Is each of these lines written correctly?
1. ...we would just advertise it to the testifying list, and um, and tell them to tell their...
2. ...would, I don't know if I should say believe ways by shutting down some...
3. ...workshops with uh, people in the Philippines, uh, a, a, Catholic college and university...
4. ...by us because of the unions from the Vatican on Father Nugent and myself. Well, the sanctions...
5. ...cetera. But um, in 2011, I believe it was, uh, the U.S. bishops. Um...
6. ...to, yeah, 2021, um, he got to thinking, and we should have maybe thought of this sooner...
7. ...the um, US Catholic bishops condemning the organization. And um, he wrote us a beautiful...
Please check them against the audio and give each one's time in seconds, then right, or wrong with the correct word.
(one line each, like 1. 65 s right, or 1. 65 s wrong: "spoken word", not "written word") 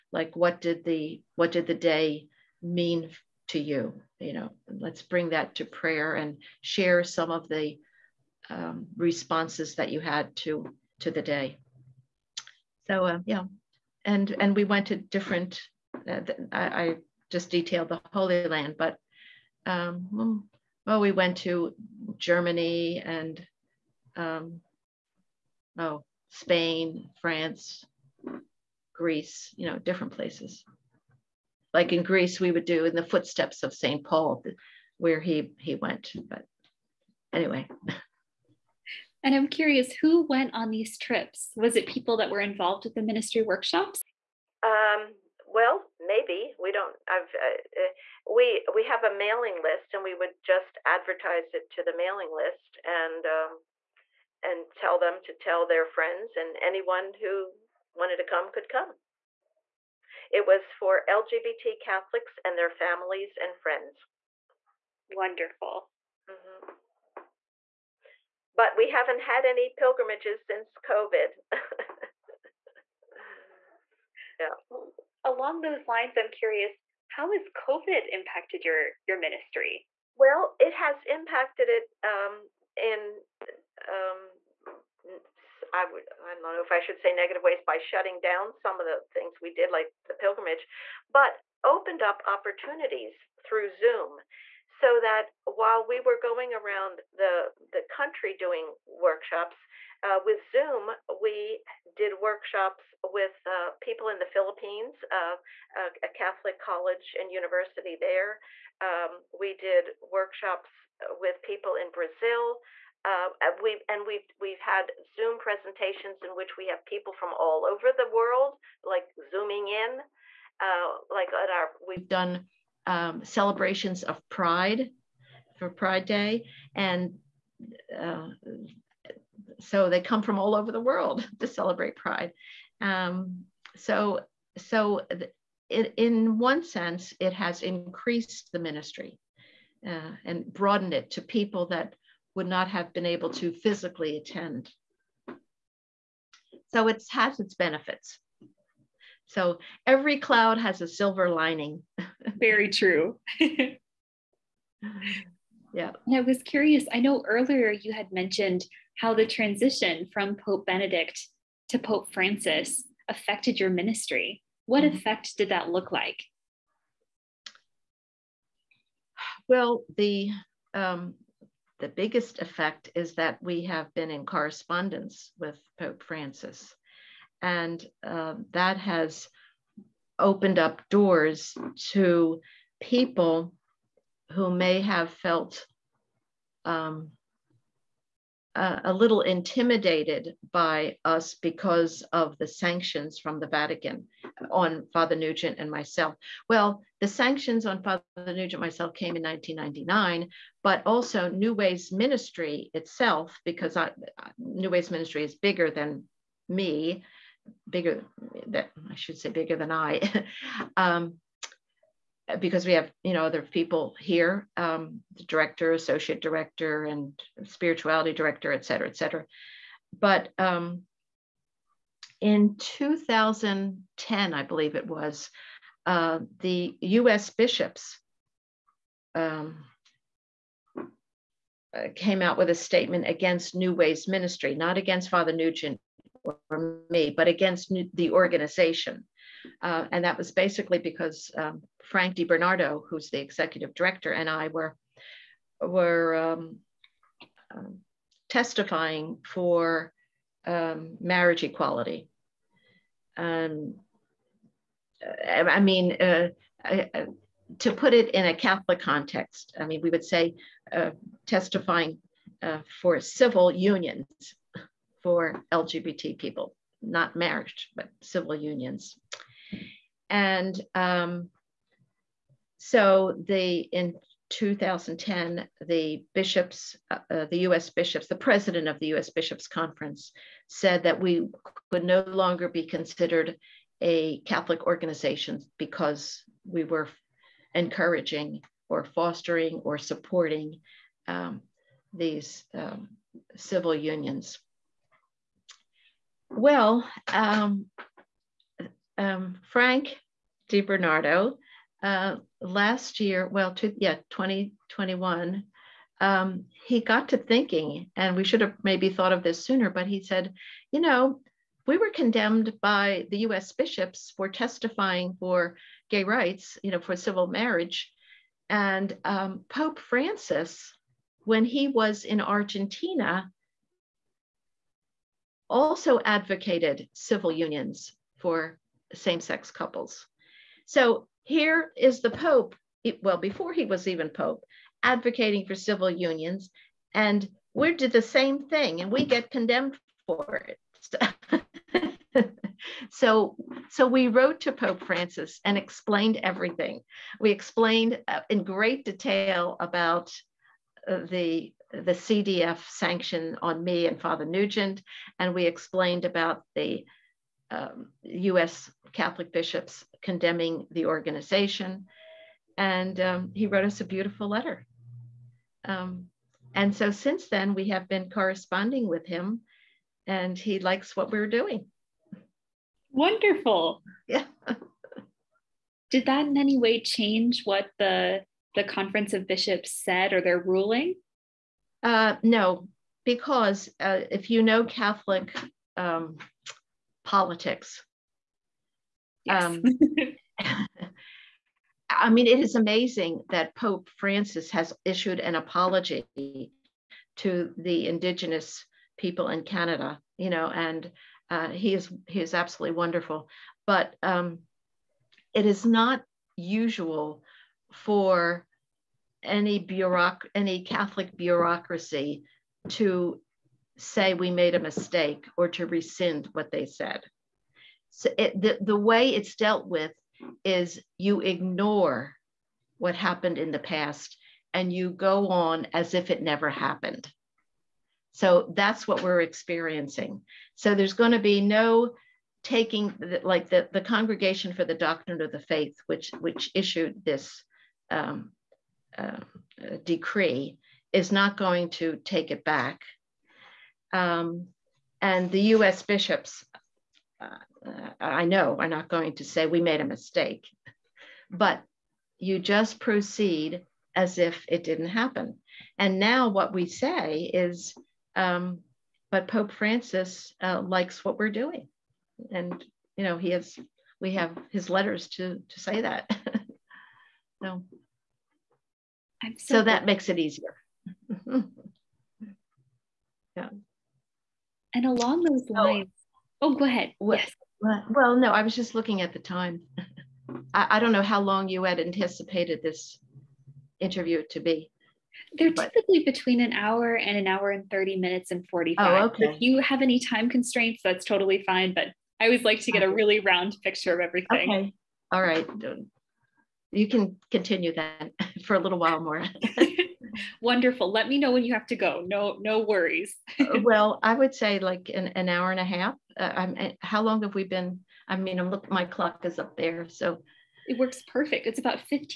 1. 50 s wrong: "mailing", not "testifying"
2. 85 s wrong: "negative", not "believe"
3. 102 s right
4. 190 s wrong: "sanctions", not "unions"
5. 218 s wrong: "2010", not "2011"
6. 303 s right
7. 356 s right.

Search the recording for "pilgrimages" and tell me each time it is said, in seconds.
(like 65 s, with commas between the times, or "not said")
69 s, 90 s.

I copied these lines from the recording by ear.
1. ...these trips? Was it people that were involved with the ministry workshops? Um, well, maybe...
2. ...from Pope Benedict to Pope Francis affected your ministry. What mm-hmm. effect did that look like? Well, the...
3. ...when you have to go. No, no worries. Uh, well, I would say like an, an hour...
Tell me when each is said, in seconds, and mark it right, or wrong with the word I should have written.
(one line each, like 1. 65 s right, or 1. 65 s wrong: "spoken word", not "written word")
1. 40 s right
2. 160 s right
3. 501 s right.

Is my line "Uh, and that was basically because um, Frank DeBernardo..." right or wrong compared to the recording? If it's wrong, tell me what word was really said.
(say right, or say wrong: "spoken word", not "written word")
right.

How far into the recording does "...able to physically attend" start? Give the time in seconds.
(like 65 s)
143 s.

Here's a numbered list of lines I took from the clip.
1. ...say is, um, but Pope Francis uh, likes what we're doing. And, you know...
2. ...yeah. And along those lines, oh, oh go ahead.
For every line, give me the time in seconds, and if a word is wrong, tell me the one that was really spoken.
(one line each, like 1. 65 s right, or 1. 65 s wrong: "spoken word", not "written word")
1. 456 s right
2. 471 s right.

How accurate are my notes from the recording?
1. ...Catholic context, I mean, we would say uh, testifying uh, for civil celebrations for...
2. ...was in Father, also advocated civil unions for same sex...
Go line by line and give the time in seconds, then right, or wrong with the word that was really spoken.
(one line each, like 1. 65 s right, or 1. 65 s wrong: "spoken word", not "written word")
1. 258 s wrong: "unions", not "celebrations"
2. 321 s wrong: "Argentina", not "Father".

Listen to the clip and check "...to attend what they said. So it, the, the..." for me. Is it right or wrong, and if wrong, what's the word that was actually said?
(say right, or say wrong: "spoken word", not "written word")
wrong: "rescind", not "attend".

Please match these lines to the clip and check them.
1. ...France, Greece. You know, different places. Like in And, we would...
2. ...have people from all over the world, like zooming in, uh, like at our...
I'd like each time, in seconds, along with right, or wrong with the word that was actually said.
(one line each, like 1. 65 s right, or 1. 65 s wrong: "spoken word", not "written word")
1. 27 s wrong: "Greece", not "And"
2. 116 s right.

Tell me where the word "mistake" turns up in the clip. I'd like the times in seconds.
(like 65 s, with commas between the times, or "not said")
414 s, 449 s.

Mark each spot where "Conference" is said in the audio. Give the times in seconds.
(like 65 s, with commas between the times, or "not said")
279 s, 378 s.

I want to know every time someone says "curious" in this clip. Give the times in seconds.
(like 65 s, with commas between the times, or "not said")
39 s, 76 s, 156 s.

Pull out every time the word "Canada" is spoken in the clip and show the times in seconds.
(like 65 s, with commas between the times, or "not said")
399 s.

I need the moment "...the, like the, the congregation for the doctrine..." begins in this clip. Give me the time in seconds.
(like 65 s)
432 s.